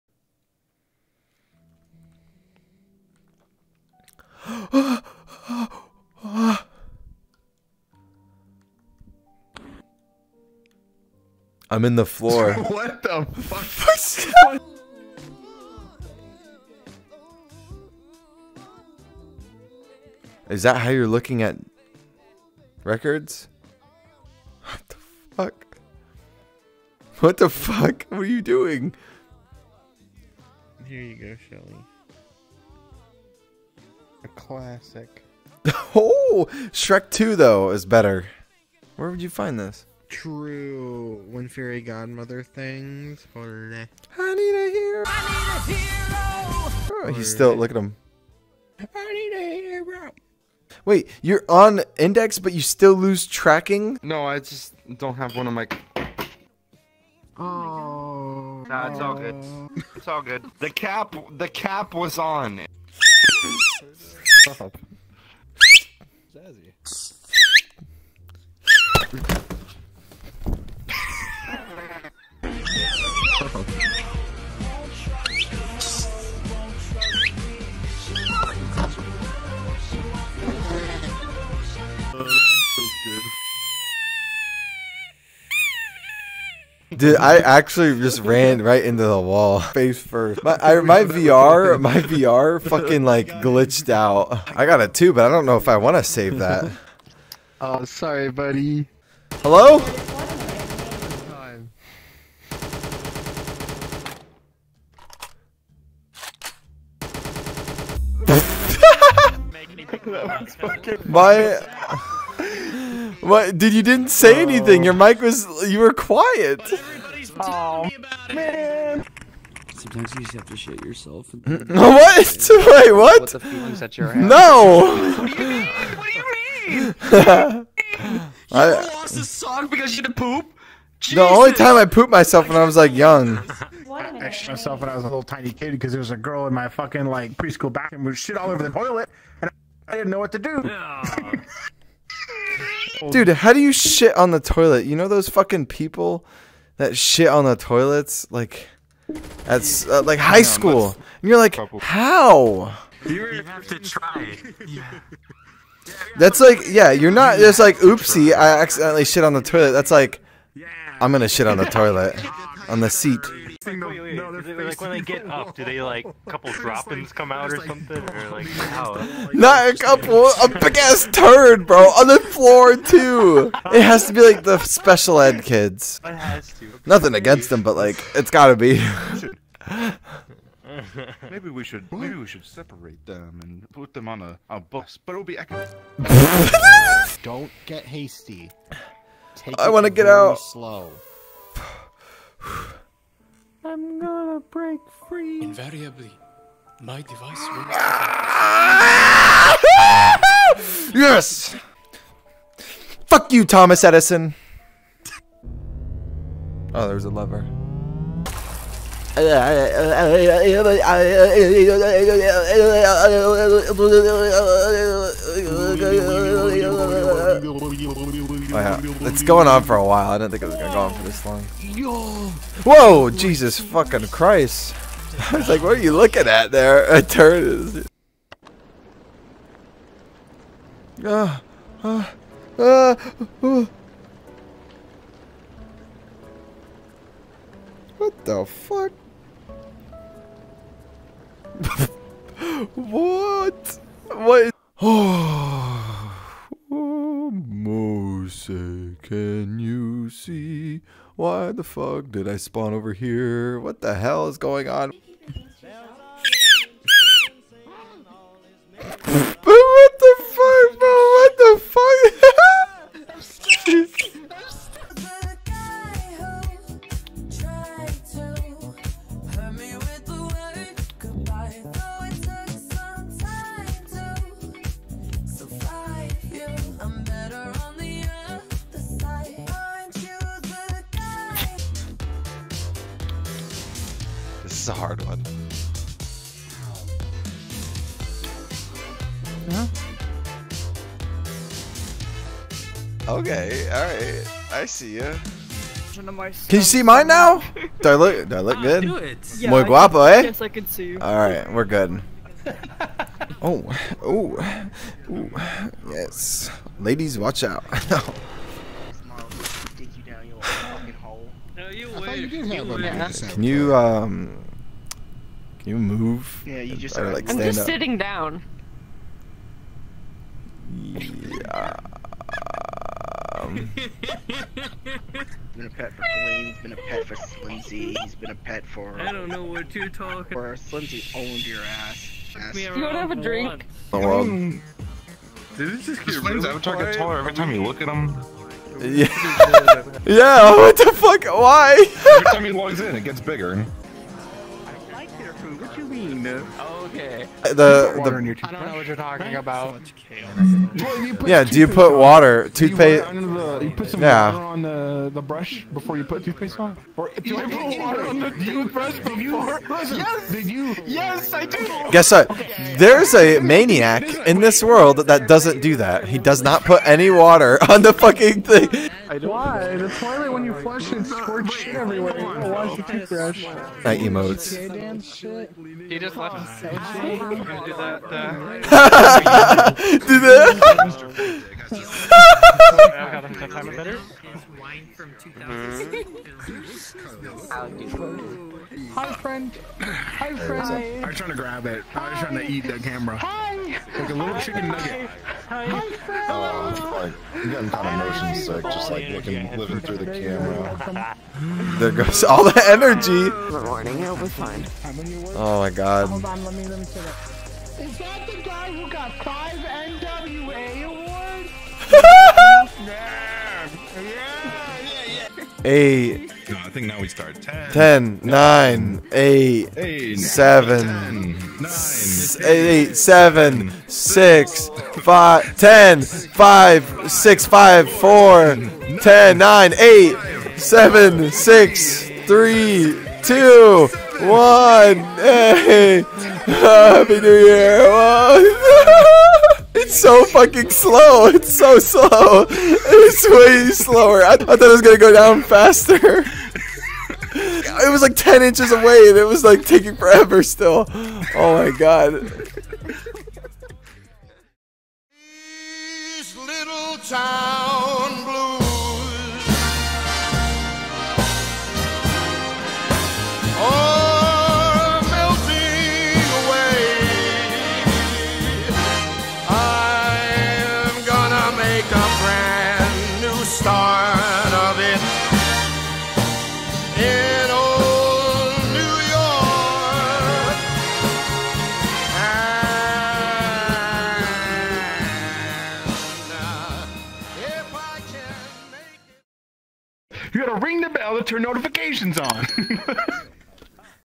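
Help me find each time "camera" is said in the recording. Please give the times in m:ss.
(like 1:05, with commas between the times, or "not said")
6:32, 6:40.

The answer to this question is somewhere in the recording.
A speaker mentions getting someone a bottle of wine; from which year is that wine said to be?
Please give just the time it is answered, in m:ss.
6:25.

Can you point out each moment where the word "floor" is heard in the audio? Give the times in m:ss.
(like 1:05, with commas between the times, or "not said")
0:12, 2:52.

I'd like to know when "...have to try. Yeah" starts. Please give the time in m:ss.
2:33.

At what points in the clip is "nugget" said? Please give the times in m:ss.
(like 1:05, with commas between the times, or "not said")
6:34.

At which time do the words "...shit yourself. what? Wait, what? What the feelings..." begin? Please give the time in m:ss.
2:00.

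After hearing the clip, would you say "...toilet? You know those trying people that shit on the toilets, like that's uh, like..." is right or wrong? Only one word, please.
wrong.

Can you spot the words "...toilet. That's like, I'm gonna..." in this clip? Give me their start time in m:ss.
2:39.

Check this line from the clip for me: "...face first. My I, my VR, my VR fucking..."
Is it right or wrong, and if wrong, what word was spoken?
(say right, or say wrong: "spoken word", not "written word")
right.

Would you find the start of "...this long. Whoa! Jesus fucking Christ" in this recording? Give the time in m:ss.
3:41.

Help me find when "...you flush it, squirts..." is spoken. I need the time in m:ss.
6:10.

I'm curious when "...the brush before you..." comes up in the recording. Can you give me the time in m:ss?
5:55.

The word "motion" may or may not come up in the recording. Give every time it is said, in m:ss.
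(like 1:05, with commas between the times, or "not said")
6:38.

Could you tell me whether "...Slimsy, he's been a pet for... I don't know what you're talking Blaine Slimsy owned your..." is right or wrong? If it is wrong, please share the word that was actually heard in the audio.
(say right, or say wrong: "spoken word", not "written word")
wrong: "For", not "Blaine".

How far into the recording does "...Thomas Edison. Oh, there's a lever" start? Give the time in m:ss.
3:23.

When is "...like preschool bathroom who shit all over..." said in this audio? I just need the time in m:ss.
2:17.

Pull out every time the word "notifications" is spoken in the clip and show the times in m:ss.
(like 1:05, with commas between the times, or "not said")
8:11.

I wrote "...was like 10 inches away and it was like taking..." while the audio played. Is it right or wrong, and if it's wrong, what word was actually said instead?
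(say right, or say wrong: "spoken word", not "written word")
right.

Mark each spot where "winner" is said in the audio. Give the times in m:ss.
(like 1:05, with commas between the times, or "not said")
not said.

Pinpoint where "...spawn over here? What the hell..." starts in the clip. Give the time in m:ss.
4:12.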